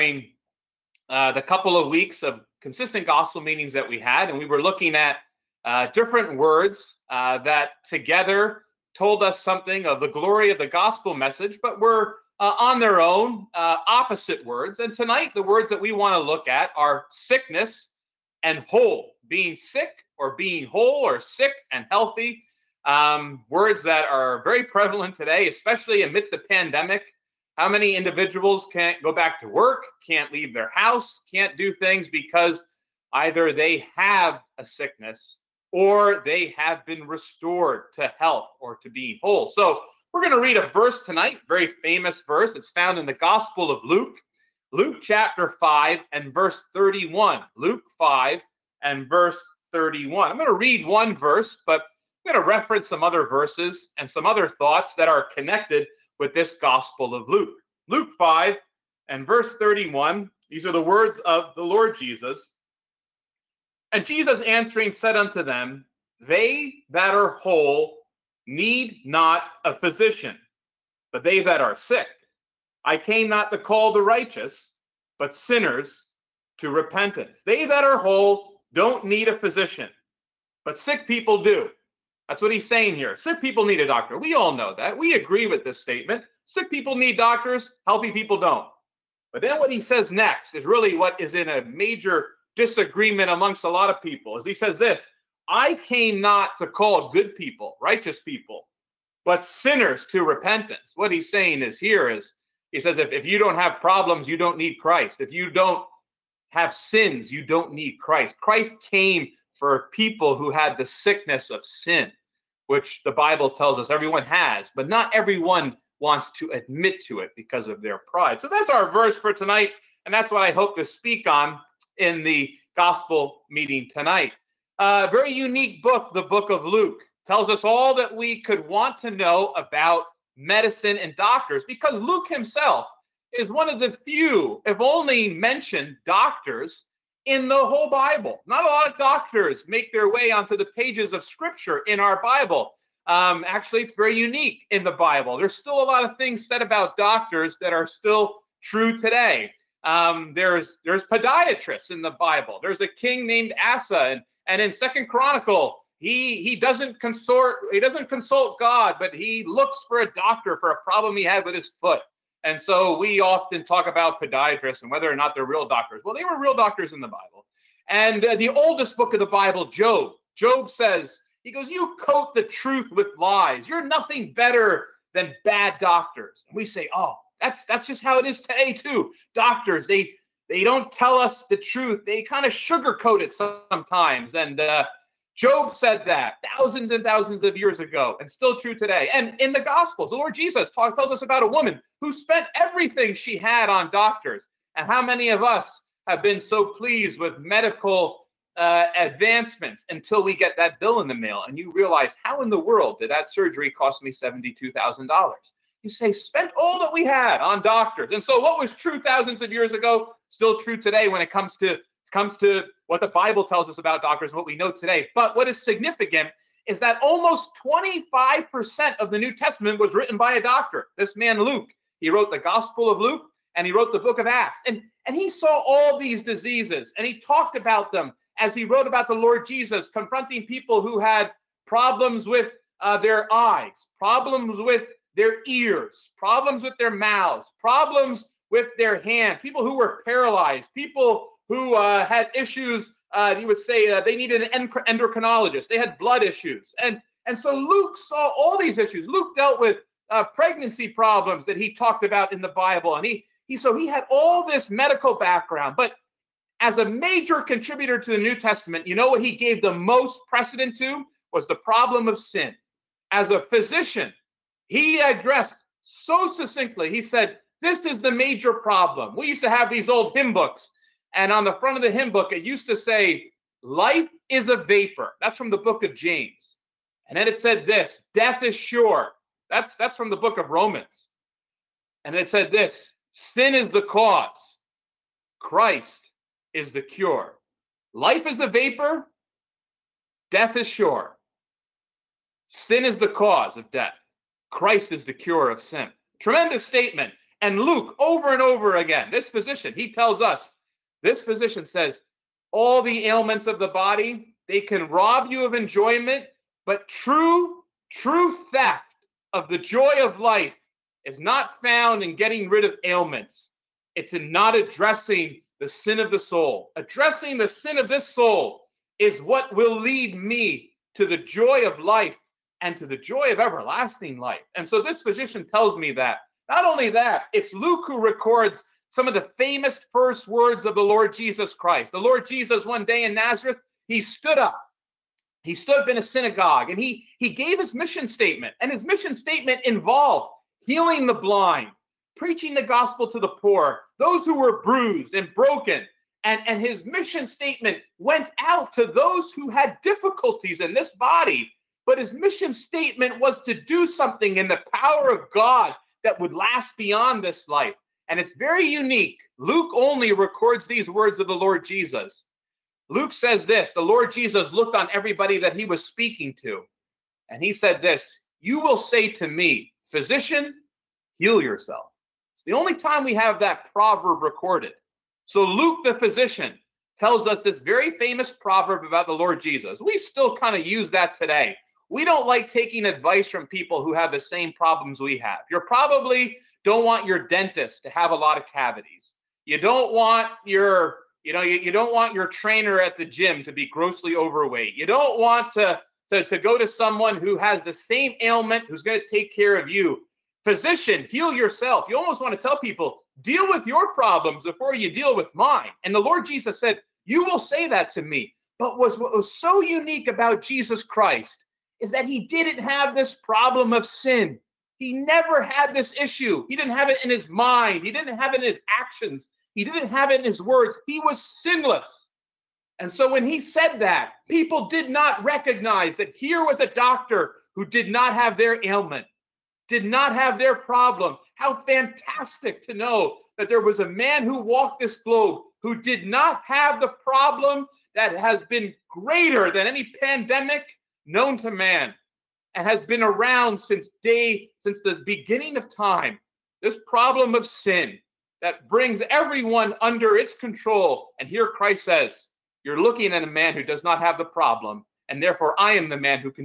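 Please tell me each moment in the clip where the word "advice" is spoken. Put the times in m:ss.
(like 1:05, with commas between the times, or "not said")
6:22.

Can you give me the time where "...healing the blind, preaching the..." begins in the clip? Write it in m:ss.
5:40.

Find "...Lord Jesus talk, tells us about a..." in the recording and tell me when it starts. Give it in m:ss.
3:10.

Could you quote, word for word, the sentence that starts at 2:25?
There's still a lot of things said about doctors that are still true today.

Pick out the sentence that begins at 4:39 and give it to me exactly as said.
That's that's from the book of Romans.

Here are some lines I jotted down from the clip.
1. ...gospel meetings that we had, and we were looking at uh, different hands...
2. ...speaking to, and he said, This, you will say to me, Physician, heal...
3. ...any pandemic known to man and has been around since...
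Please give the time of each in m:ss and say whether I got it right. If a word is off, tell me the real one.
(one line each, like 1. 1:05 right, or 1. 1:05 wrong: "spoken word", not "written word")
1. 0:03 wrong: "words", not "hands"
2. 6:05 right
3. 7:19 right.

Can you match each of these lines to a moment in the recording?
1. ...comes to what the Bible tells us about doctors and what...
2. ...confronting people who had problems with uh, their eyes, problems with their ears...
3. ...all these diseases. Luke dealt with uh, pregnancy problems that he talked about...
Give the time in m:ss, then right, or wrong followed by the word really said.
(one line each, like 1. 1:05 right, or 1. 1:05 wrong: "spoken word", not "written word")
1. 3:32 right
2. 3:49 right
3. 4:08 wrong: "issues", not "diseases".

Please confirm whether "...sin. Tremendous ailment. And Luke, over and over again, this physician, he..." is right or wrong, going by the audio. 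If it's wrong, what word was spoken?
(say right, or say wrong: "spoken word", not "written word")
wrong: "statement", not "ailment".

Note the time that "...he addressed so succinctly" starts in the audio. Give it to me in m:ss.
4:24.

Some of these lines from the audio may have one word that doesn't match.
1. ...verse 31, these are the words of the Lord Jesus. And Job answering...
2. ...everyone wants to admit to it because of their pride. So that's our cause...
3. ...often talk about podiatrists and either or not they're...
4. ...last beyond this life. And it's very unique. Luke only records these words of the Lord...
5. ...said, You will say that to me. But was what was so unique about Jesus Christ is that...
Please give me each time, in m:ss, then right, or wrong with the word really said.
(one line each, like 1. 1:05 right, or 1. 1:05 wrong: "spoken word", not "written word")
1. 0:59 wrong: "Jesus", not "Job"
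2. 1:55 wrong: "verse", not "cause"
3. 2:43 wrong: "whether", not "either"
4. 5:56 right
5. 6:46 right.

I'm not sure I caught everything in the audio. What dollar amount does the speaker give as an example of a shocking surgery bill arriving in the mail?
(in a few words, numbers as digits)
$72,000.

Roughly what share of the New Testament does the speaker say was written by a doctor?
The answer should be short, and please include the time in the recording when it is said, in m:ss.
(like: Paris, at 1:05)
25%, at 3:37.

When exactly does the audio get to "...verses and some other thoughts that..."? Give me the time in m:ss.
0:53.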